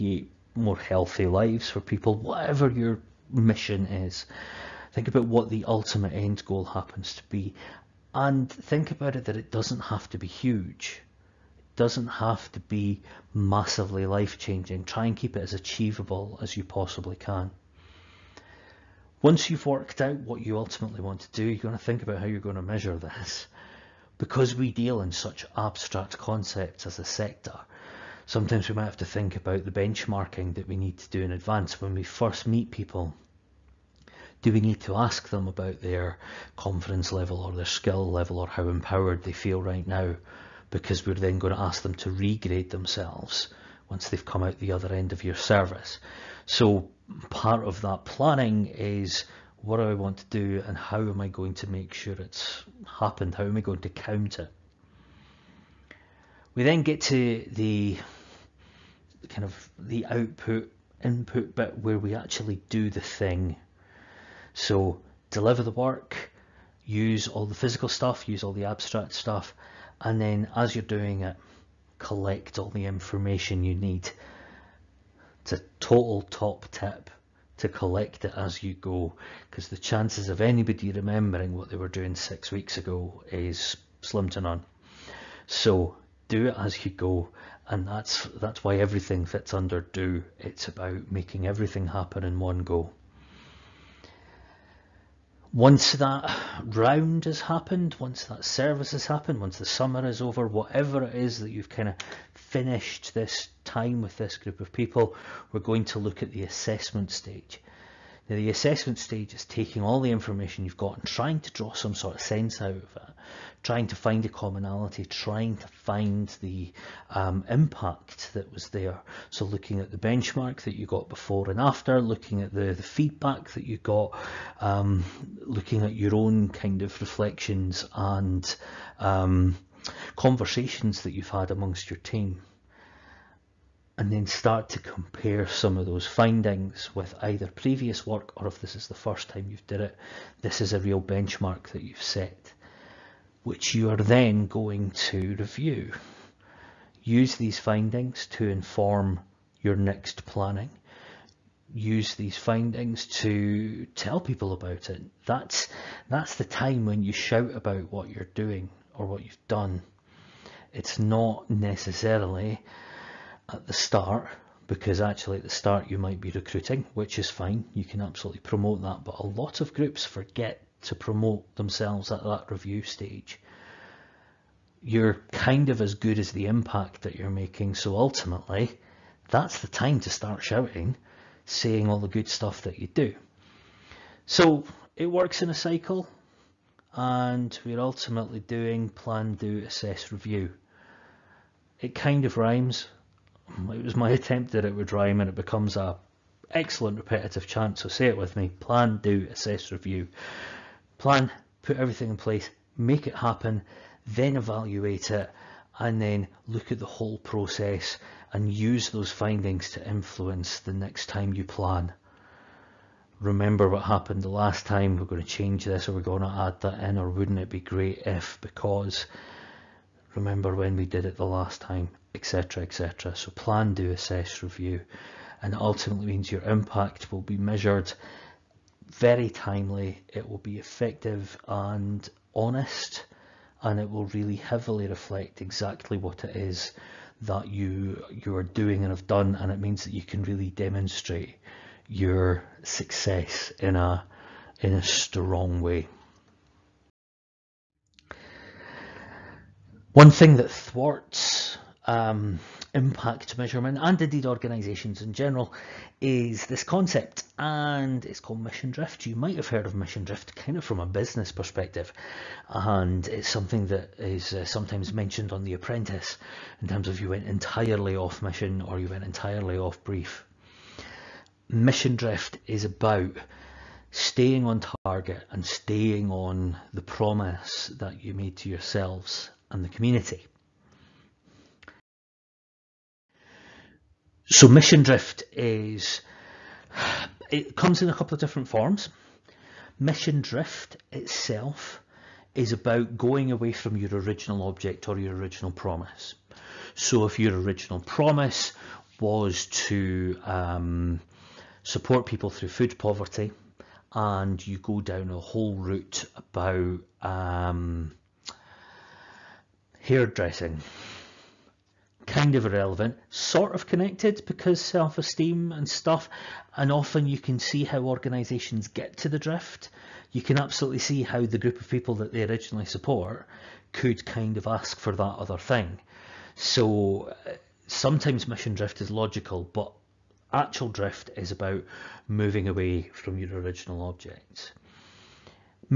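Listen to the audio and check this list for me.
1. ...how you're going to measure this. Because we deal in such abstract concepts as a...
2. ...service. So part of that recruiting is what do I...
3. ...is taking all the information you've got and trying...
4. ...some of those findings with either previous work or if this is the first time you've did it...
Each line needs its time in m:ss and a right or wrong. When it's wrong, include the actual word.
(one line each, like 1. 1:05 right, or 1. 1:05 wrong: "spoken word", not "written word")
1. 0:22 right
2. 0:45 wrong: "planning", not "recruiting"
3. 1:49 right
4. 2:15 right.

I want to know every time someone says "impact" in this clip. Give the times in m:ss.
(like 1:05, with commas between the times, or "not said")
1:57, 2:56, 3:46, 4:12.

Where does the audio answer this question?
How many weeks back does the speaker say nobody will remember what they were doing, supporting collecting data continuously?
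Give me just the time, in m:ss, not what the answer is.
1:22.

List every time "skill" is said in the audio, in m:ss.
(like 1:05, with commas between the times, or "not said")
0:37.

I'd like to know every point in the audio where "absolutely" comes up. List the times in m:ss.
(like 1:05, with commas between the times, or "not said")
2:48, 5:20.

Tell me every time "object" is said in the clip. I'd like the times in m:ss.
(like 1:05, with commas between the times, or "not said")
4:54, 5:33.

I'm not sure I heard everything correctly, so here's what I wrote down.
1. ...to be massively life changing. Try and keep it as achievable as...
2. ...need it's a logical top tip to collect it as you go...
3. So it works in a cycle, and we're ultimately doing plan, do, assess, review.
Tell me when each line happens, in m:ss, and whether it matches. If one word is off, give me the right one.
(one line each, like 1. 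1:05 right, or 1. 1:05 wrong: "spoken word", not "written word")
1. 0:12 right
2. 1:13 wrong: "total", not "logical"
3. 3:04 right.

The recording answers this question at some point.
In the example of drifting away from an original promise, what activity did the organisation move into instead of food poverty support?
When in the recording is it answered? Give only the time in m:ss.
5:09.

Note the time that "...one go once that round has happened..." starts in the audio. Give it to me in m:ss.
1:32.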